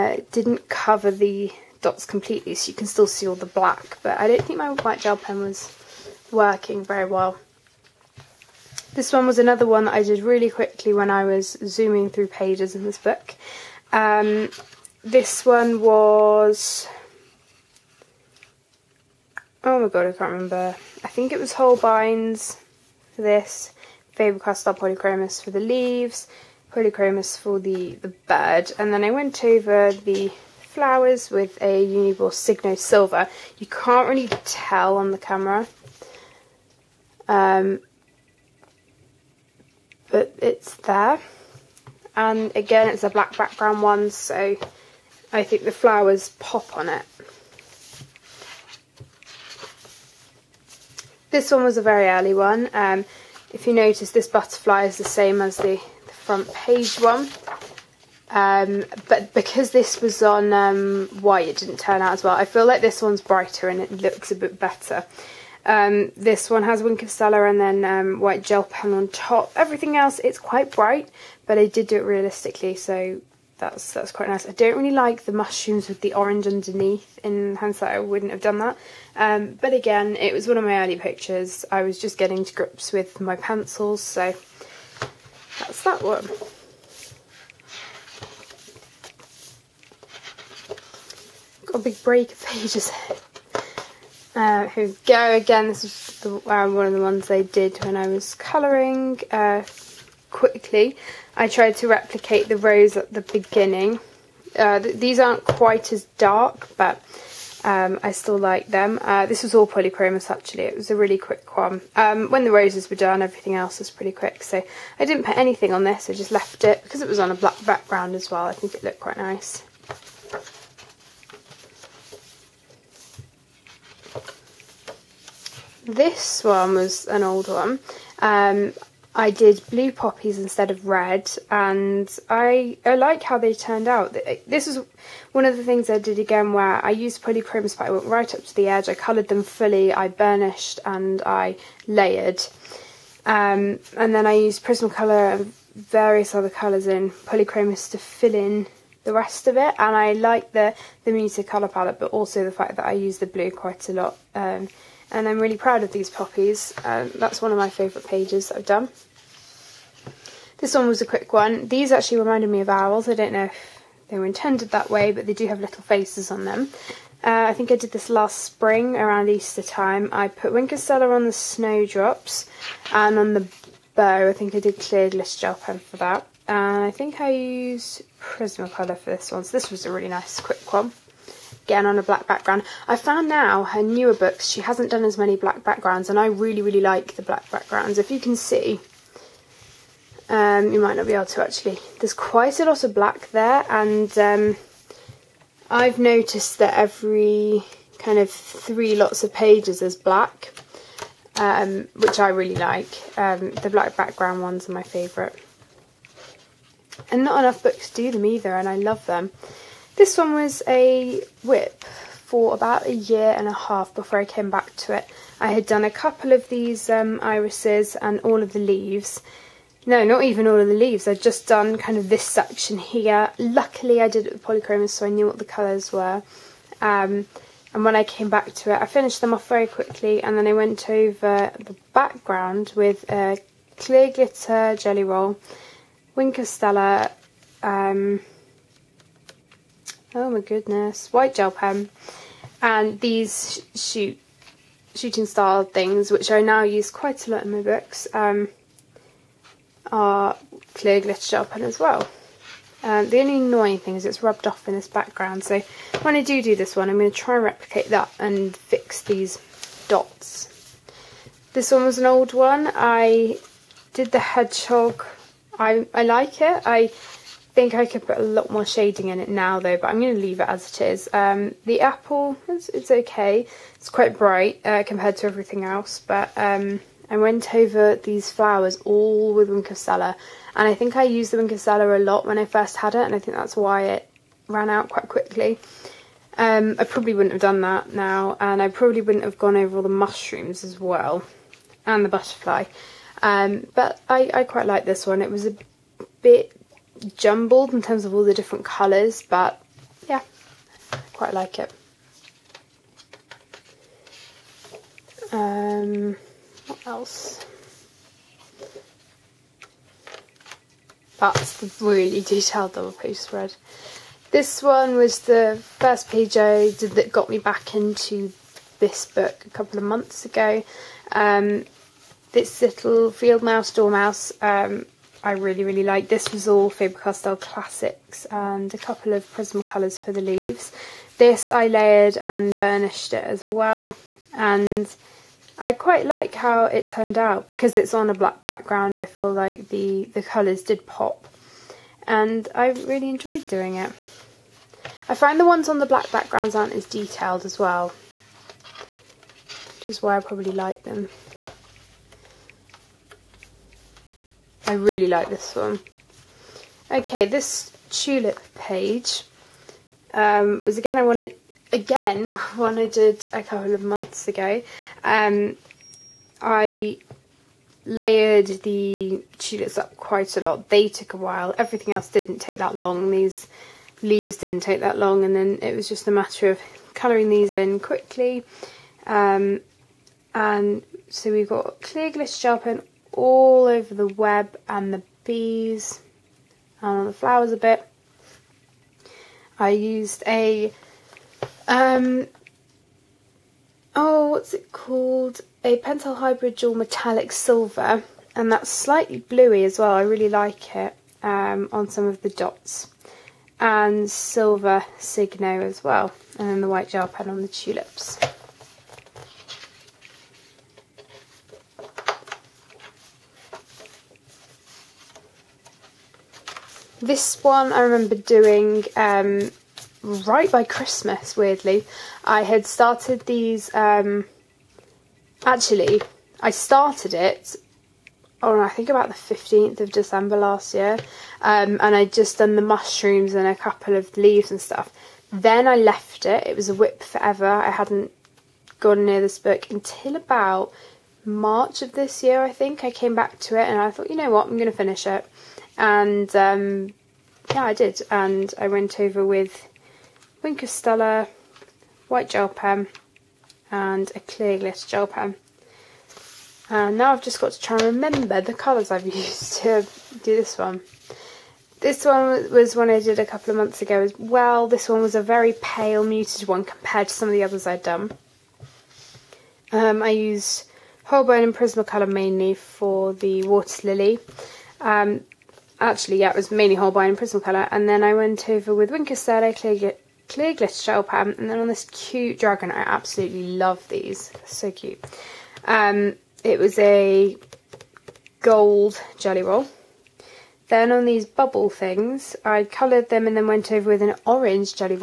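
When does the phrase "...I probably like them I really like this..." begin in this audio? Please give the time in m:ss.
5:50.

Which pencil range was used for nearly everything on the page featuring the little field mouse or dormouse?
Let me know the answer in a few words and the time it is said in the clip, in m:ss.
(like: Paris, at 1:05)
Faber-Castell classics, at 5:26.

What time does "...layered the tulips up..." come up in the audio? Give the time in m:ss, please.
6:07.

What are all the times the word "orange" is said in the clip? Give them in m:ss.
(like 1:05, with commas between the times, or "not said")
1:16, 8:14.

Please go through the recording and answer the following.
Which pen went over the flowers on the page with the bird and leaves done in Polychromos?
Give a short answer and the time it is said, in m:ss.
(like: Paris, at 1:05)
Uniball Signo Silver, at 0:31.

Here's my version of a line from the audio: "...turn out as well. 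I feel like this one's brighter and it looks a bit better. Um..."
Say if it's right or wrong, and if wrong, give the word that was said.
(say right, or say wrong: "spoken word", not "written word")
right.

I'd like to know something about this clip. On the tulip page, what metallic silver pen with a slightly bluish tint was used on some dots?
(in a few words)
Pentel Hybrid Dual Metallic Silver.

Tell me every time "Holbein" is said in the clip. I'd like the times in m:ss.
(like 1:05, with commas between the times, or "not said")
0:21, 7:51, 7:56.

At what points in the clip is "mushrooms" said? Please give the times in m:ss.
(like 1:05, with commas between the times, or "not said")
1:15, 4:49, 7:12.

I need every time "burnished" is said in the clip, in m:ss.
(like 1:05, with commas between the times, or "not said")
2:20, 5:32.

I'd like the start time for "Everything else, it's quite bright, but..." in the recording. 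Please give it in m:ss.
1:09.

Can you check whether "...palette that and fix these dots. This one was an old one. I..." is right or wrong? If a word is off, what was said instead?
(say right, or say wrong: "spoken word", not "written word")
wrong: "replicate", not "palette".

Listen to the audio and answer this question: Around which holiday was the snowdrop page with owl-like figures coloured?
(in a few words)
Easter.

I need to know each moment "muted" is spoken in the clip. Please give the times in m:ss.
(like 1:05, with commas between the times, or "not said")
2:31, 7:46.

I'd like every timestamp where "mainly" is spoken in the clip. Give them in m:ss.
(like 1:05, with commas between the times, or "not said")
7:52, 7:56.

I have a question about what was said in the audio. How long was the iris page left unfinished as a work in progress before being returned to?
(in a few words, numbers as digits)
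A year and a half.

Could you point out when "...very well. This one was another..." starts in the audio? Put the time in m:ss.
0:06.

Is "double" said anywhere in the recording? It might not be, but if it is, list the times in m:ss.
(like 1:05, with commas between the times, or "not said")
5:12.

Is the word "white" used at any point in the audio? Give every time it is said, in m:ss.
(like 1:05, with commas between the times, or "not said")
0:04, 1:01, 1:08, 4:01, 6:46, 7:32.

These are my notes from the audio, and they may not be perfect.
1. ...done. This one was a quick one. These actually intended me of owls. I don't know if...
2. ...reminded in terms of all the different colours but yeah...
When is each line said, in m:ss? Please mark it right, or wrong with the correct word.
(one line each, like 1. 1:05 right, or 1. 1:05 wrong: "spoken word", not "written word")
1. 2:38 wrong: "reminded", not "intended"
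2. 4:57 wrong: "jumbled", not "reminded".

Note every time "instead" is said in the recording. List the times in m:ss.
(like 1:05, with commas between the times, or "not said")
2:10.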